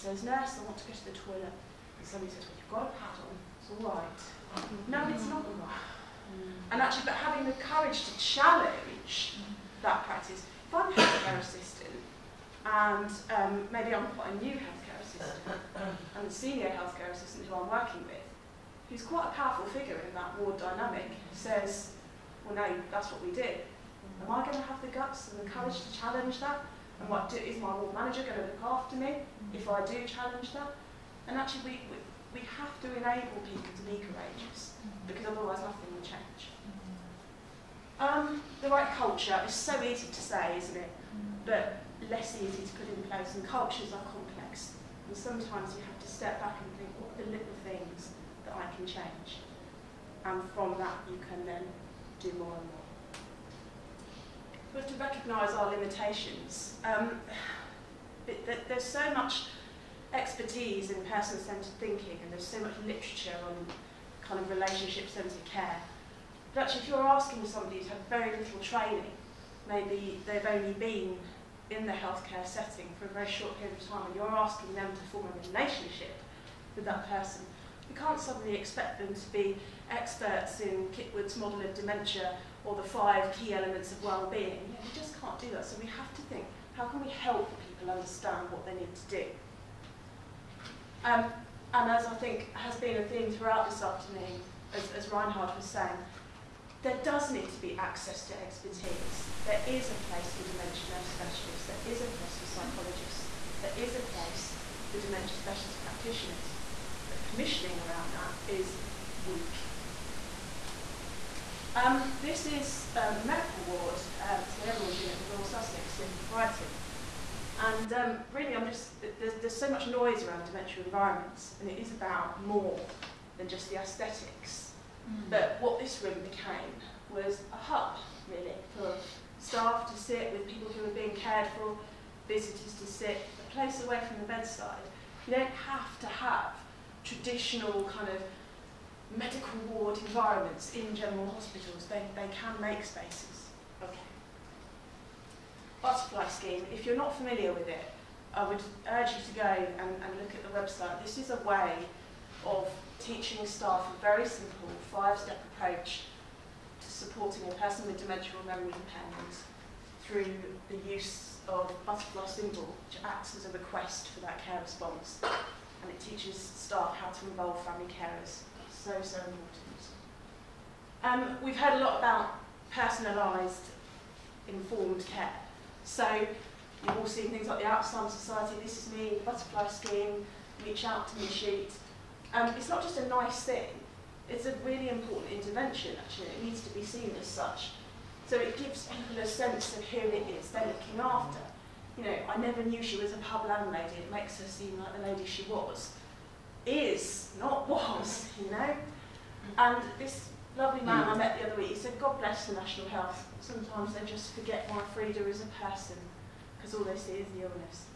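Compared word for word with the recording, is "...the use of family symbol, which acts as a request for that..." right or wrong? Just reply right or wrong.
wrong.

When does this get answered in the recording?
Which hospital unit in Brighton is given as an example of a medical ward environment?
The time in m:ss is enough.
1:54.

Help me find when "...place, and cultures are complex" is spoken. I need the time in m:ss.
0:43.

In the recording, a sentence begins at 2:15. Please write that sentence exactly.
You don't have to have traditional kind of medical ward environments in general hospitals.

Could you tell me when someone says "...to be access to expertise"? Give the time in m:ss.
1:37.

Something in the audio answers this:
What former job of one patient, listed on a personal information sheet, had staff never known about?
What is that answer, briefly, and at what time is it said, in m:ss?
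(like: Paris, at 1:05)
pub landlady, at 3:13.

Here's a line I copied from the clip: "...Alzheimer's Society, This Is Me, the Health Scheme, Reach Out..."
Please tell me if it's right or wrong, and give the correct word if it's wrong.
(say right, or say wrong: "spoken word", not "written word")
wrong: "Butterfly", not "Health".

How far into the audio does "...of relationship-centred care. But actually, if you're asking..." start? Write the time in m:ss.
1:04.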